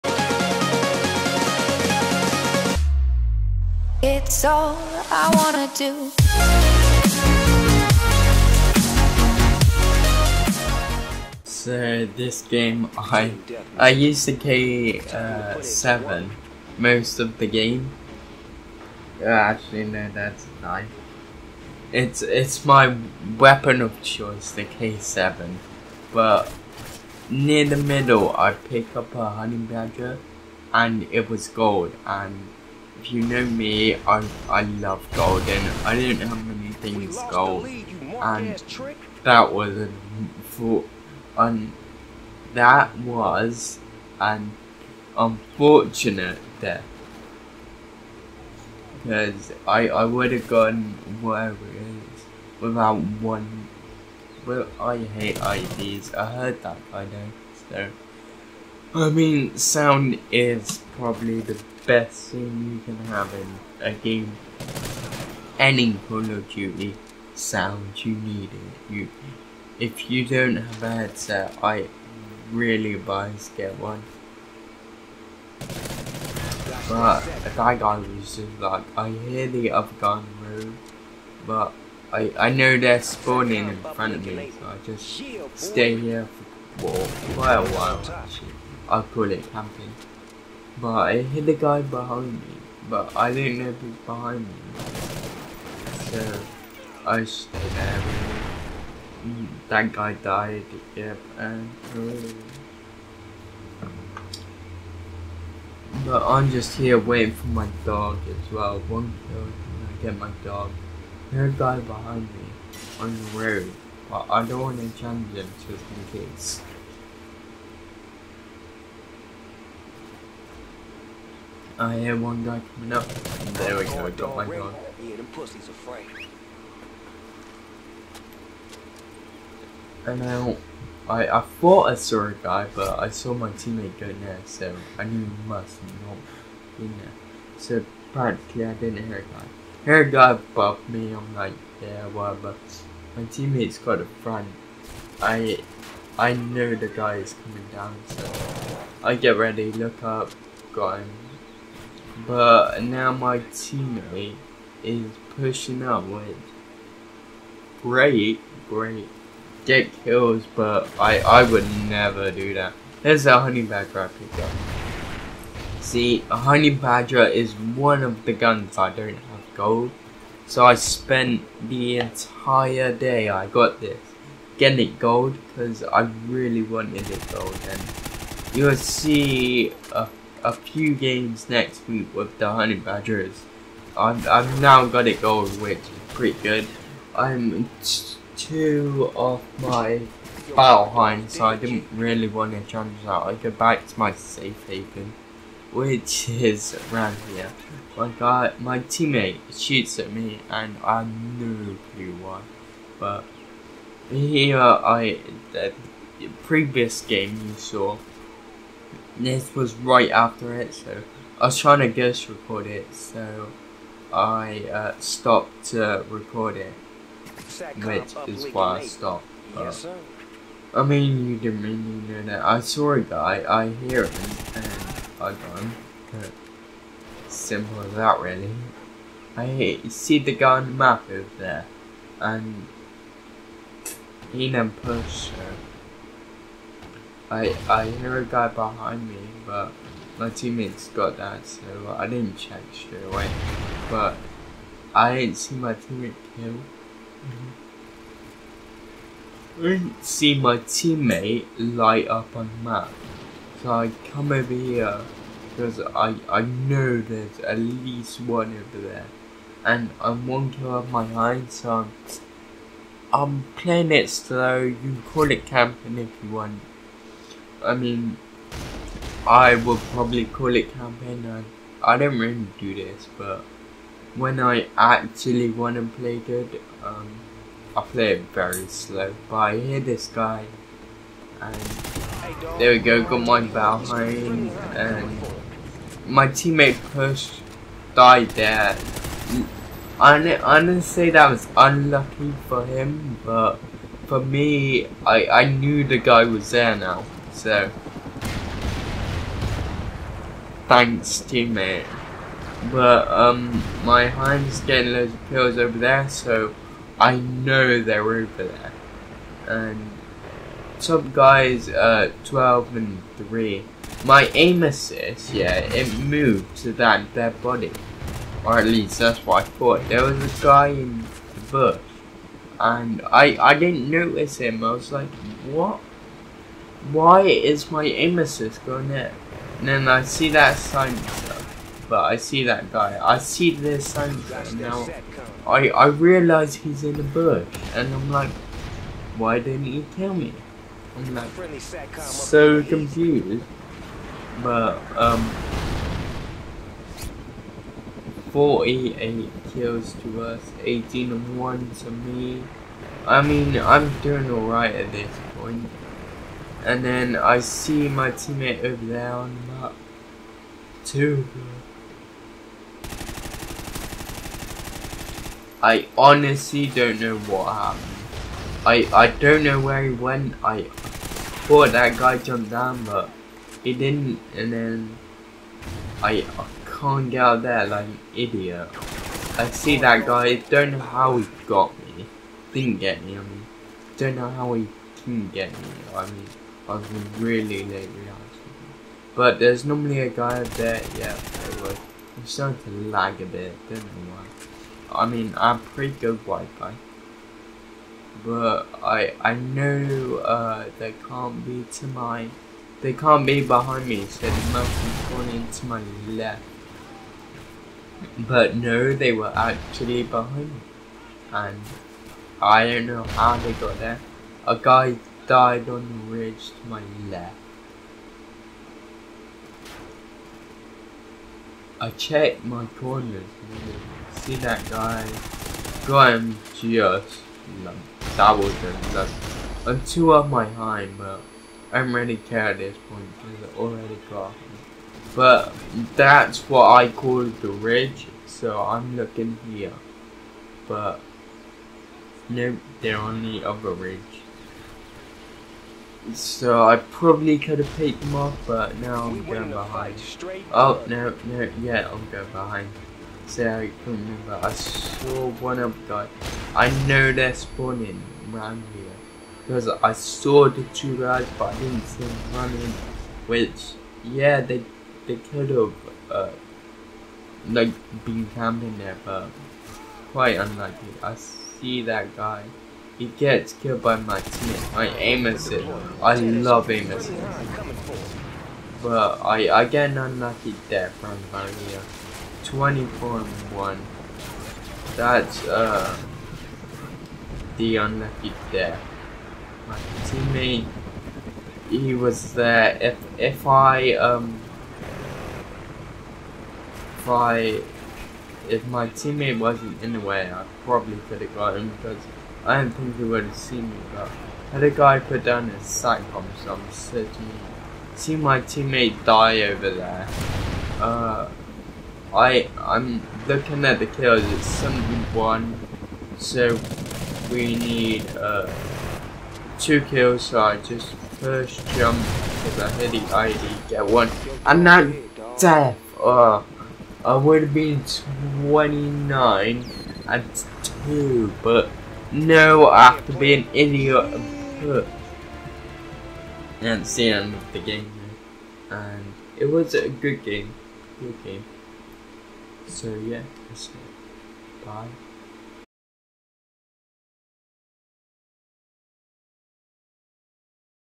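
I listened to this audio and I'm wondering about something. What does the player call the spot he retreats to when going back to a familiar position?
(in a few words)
safe haven.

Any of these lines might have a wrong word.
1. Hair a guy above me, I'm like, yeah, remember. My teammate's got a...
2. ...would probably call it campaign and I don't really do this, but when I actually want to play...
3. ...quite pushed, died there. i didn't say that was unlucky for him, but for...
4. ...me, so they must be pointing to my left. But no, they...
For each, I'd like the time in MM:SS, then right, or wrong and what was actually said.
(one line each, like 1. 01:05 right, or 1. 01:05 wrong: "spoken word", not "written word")
1. 02:19 wrong: "whatever", not "remember"
2. 04:29 right
3. 04:46 wrong: "teammate", not "quite"
4. 06:43 right.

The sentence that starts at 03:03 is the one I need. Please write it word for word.
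I'm, I'm now got it going, which is pretty good.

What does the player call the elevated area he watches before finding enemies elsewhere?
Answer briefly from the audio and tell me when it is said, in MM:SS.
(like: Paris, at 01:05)
the ridge, at 07:17.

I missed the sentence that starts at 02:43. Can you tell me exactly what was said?
There's a honey badger I picked up.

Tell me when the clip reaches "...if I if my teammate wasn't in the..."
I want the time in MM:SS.
08:16.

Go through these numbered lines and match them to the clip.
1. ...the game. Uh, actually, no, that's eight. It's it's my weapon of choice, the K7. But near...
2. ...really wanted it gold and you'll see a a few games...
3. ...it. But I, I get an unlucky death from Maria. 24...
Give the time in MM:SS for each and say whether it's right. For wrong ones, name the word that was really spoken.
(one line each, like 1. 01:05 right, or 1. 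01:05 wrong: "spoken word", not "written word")
1. 00:17 wrong: "nine", not "eight"
2. 02:56 right
3. 07:57 right.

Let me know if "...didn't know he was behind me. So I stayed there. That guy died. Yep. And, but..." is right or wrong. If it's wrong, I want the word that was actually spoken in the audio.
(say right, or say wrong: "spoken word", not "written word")
right.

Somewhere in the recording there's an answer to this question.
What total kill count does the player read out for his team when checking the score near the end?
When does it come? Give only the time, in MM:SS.
08:34.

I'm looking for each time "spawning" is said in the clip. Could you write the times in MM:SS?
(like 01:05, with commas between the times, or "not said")
01:23, 07:37.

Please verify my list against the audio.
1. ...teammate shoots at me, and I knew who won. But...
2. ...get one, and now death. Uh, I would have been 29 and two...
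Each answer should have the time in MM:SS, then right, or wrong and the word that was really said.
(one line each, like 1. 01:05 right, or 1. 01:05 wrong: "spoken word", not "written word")
1. 03:18 right
2. 08:43 right.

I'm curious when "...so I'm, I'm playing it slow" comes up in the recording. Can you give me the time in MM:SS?
04:21.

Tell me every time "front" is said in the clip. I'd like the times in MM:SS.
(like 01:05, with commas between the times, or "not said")
01:23, 02:24.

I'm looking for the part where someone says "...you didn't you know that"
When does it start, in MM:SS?
03:41.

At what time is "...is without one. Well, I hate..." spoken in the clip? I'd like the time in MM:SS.
00:51.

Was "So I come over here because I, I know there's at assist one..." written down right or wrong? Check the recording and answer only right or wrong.
wrong.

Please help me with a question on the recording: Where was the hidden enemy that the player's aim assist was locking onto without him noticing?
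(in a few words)
in a bush.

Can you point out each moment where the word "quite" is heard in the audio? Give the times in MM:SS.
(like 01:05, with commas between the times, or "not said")
01:27, 07:50.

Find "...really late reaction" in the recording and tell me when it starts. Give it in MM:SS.
06:27.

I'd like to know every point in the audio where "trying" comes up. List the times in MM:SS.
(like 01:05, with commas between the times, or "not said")
03:31.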